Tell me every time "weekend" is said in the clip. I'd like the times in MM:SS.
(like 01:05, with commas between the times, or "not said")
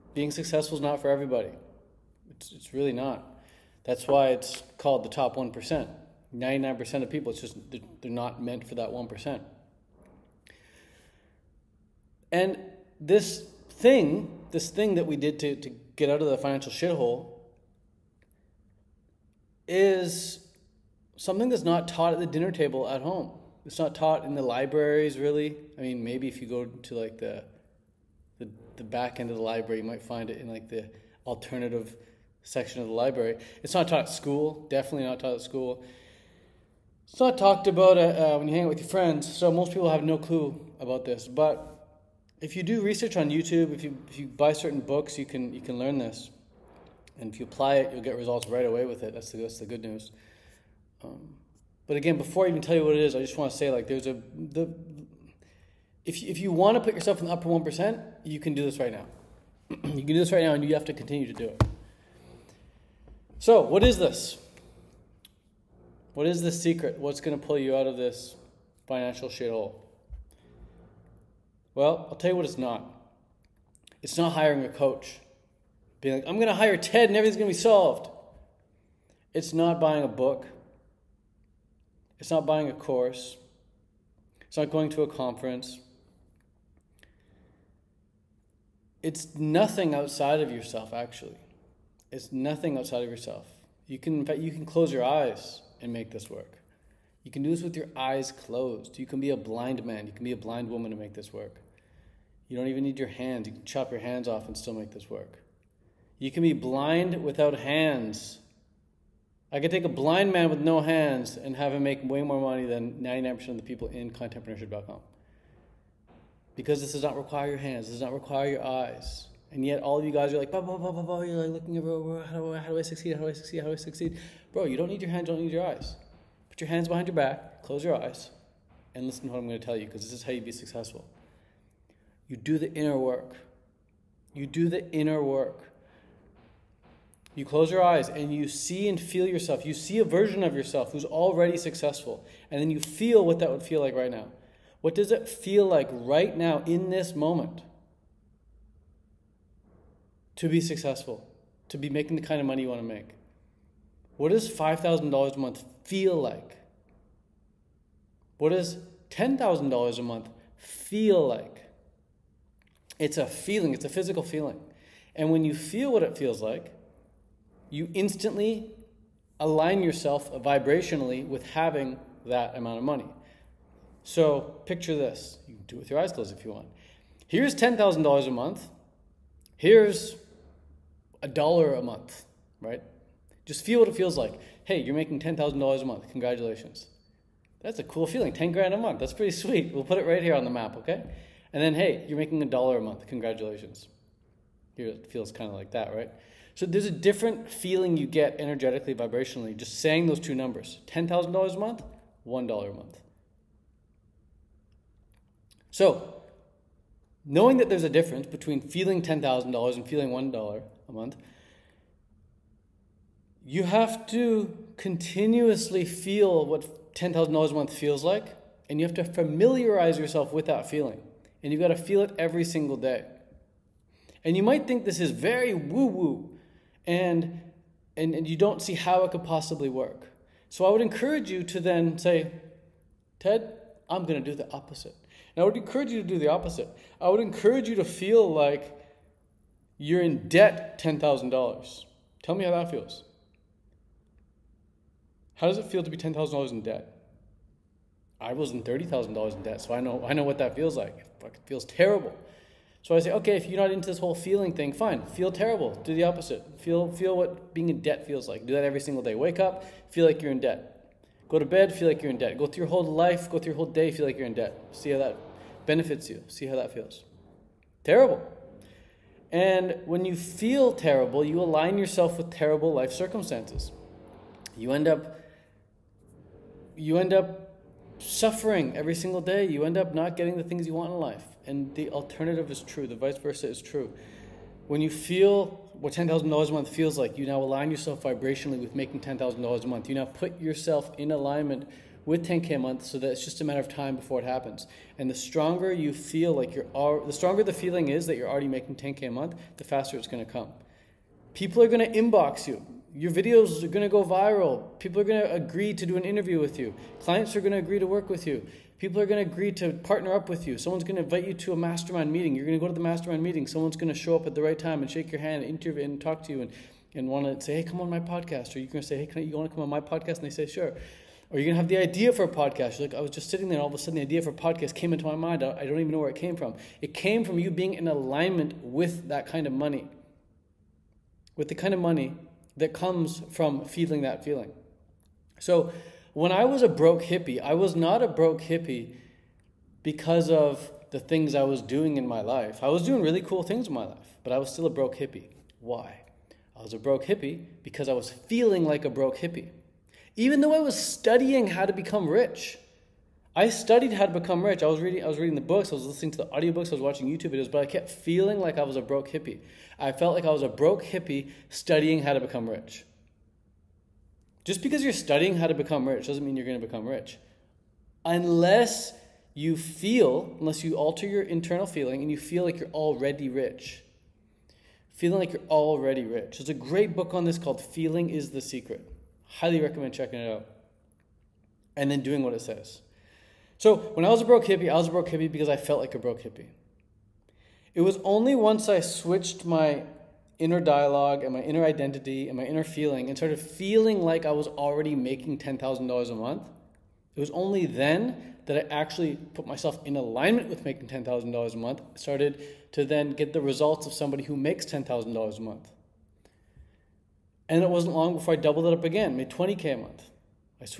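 not said.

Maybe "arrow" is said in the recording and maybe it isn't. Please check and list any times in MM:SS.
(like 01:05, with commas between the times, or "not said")
not said.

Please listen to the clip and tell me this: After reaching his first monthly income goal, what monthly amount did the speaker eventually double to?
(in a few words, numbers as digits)
20K a month.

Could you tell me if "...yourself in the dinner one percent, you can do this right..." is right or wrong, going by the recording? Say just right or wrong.
wrong.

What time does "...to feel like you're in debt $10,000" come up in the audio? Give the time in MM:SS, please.
03:57.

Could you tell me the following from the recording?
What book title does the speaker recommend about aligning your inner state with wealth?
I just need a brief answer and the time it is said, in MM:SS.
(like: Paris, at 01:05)
Feeling is the Secret, at 06:17.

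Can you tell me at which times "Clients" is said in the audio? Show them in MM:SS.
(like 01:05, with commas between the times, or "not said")
05:06.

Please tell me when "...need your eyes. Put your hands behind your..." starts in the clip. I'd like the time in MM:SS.
02:05.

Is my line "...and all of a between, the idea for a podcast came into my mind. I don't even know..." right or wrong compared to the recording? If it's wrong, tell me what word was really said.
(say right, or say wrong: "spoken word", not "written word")
wrong: "sudden", not "between".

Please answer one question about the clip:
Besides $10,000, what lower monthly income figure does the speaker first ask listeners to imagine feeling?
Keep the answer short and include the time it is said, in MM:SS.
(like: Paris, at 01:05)
$5,000 a month, at 02:34.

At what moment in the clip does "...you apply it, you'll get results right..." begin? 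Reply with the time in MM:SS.
00:47.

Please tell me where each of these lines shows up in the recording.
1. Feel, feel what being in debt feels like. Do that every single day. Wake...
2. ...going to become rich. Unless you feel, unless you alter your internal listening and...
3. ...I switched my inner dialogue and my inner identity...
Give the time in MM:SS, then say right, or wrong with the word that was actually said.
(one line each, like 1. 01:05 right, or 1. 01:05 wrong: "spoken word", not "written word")
1. 04:16 right
2. 06:06 wrong: "feeling", not "listening"
3. 06:28 right.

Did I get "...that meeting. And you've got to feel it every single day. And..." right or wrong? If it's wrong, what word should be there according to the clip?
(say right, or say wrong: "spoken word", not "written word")
wrong: "feeling", not "meeting".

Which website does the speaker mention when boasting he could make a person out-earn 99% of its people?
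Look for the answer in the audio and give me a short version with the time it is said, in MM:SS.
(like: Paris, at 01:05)
contentpreneurship.com, at 01:54.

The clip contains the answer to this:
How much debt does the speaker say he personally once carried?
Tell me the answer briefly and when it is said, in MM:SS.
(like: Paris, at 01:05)
$30,000, at 04:08.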